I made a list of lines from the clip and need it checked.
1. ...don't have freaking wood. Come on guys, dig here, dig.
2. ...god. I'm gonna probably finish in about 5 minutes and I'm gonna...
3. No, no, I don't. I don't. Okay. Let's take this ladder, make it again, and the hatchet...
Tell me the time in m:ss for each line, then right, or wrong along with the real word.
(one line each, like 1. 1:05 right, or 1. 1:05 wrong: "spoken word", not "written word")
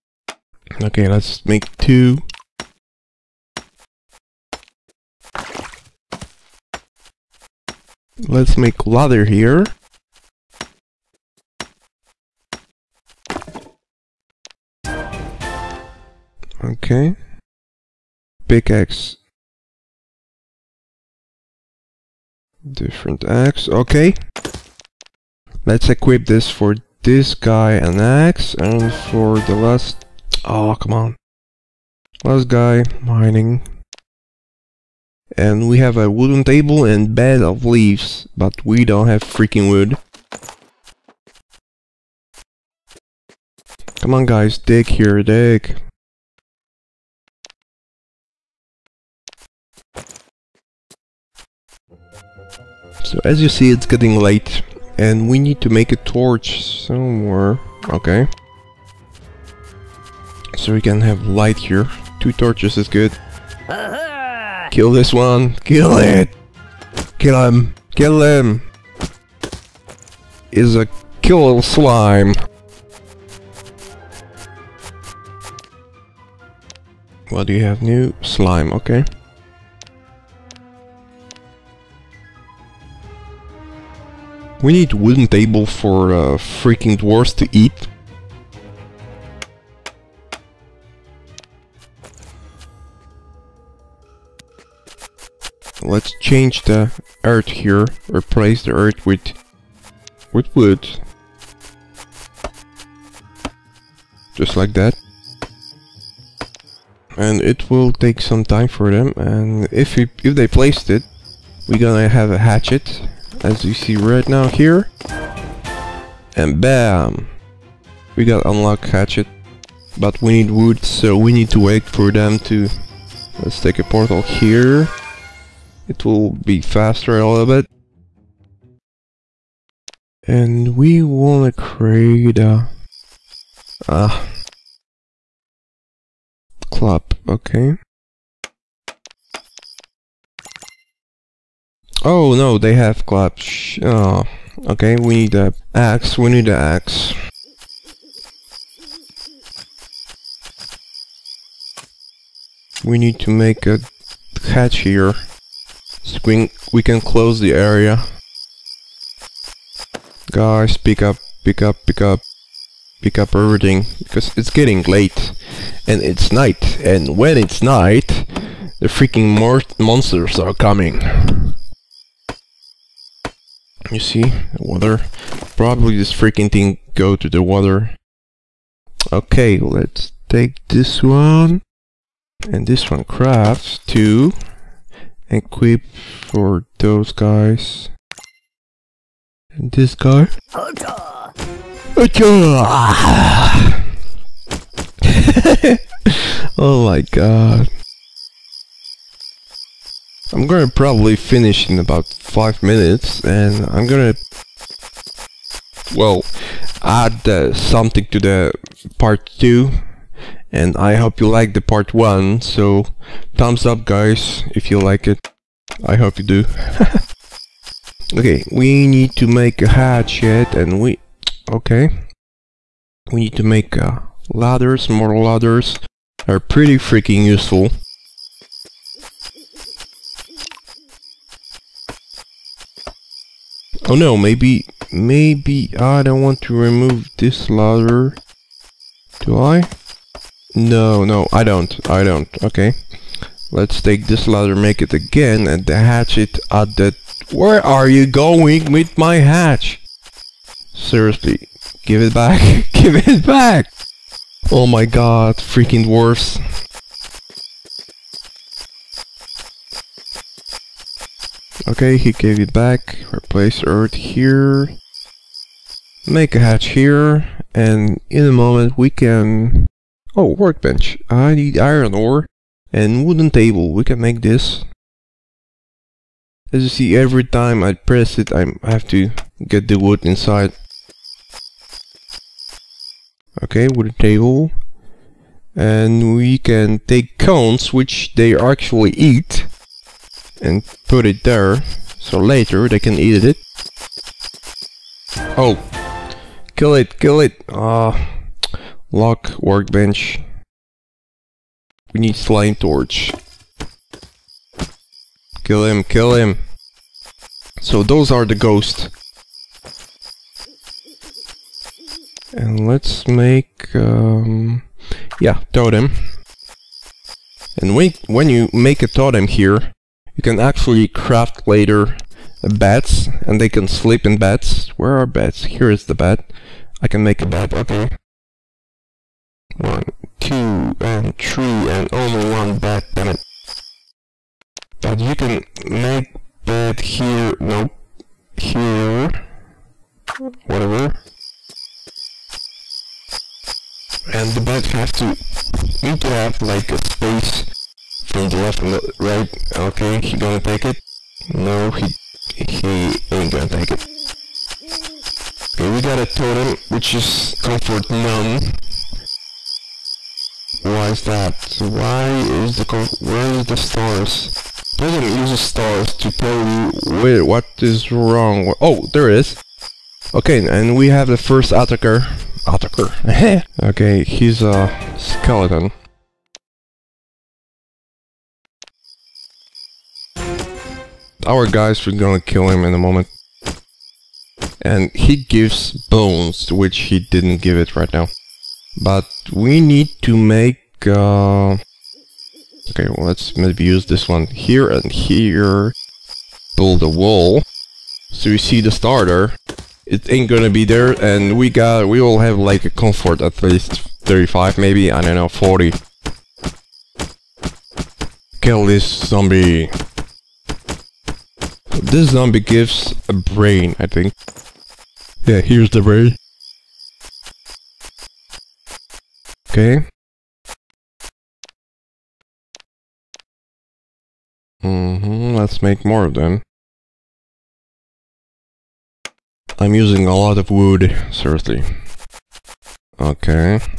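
1. 0:38 right
2. 3:17 right
3. 4:00 right.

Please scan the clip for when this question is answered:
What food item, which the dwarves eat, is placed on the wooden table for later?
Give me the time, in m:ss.
4:47.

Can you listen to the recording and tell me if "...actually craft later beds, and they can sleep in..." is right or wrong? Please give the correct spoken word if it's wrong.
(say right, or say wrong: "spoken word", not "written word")
right.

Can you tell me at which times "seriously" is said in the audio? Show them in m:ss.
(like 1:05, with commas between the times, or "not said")
4:10, 7:11.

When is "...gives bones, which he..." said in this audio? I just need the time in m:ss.
6:25.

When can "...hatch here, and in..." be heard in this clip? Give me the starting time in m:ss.
4:26.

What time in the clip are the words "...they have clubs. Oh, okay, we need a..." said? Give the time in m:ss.
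2:22.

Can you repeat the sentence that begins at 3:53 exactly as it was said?
Oh no, maybe, maybe I don't want to remove this ladder.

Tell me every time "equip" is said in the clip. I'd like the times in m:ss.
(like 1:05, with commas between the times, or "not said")
0:25, 3:05.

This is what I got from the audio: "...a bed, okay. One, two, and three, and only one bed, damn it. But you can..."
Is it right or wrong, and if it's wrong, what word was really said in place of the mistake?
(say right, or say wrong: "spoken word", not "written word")
right.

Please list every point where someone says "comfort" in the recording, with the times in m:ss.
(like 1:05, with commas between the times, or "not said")
5:57, 6:42.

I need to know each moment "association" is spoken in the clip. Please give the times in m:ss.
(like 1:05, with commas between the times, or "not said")
not said.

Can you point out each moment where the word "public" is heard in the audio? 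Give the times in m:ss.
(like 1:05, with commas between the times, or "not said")
not said.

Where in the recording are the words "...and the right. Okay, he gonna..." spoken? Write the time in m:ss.
5:48.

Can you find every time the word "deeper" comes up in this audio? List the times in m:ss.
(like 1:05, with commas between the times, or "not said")
not said.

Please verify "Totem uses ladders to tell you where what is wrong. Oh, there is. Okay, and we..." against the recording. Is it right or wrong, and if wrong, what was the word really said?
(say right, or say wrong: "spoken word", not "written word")
wrong: "stars", not "ladders".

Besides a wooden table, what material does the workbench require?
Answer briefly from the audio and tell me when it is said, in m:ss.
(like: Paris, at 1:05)
Iron ore, at 4:31.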